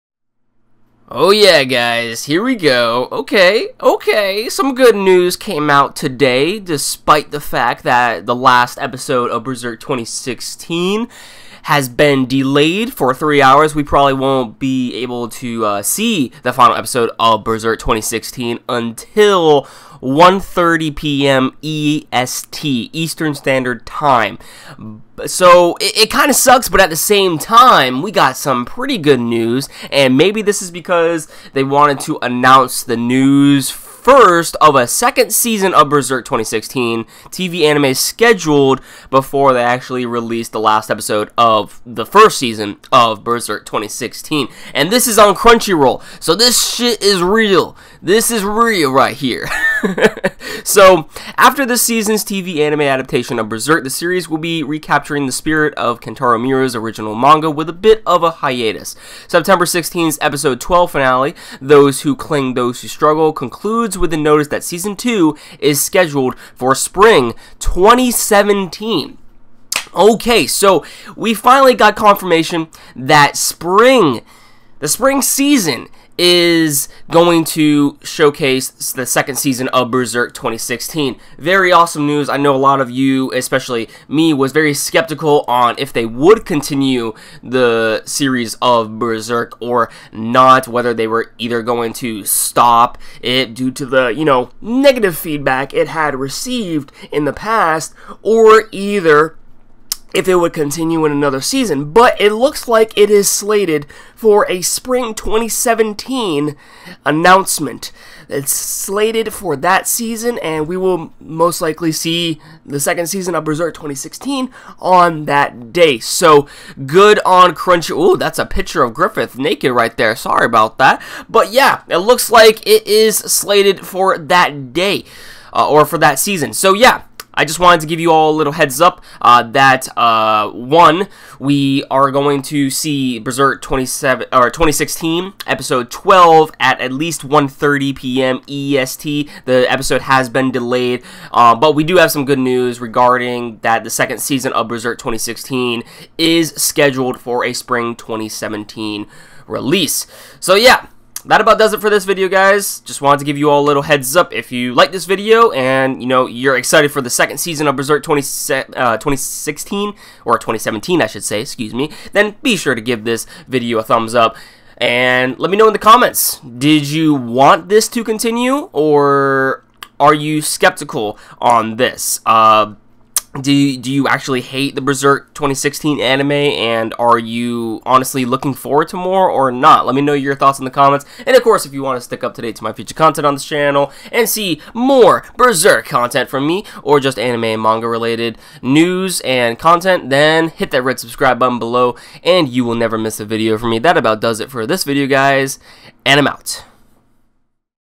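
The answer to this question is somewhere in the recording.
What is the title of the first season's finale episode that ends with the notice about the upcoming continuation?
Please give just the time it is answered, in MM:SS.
01:01.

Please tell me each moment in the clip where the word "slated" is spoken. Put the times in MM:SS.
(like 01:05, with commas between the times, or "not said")
01:43, 01:48, 02:03.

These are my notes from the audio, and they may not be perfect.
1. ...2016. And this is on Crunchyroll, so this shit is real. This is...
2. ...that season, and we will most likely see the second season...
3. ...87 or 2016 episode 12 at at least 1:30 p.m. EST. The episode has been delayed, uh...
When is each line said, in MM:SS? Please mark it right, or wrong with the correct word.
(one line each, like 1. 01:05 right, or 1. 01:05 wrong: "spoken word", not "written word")
1. 00:43 right
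2. 01:49 right
3. 02:13 wrong: "27", not "87".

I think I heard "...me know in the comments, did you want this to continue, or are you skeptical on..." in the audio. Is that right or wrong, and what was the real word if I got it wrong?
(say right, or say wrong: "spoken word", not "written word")
right.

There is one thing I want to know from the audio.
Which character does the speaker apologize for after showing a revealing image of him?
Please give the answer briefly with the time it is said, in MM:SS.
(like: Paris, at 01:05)
Griffith, at 01:58.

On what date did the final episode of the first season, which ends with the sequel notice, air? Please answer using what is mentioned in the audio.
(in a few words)
September 16th.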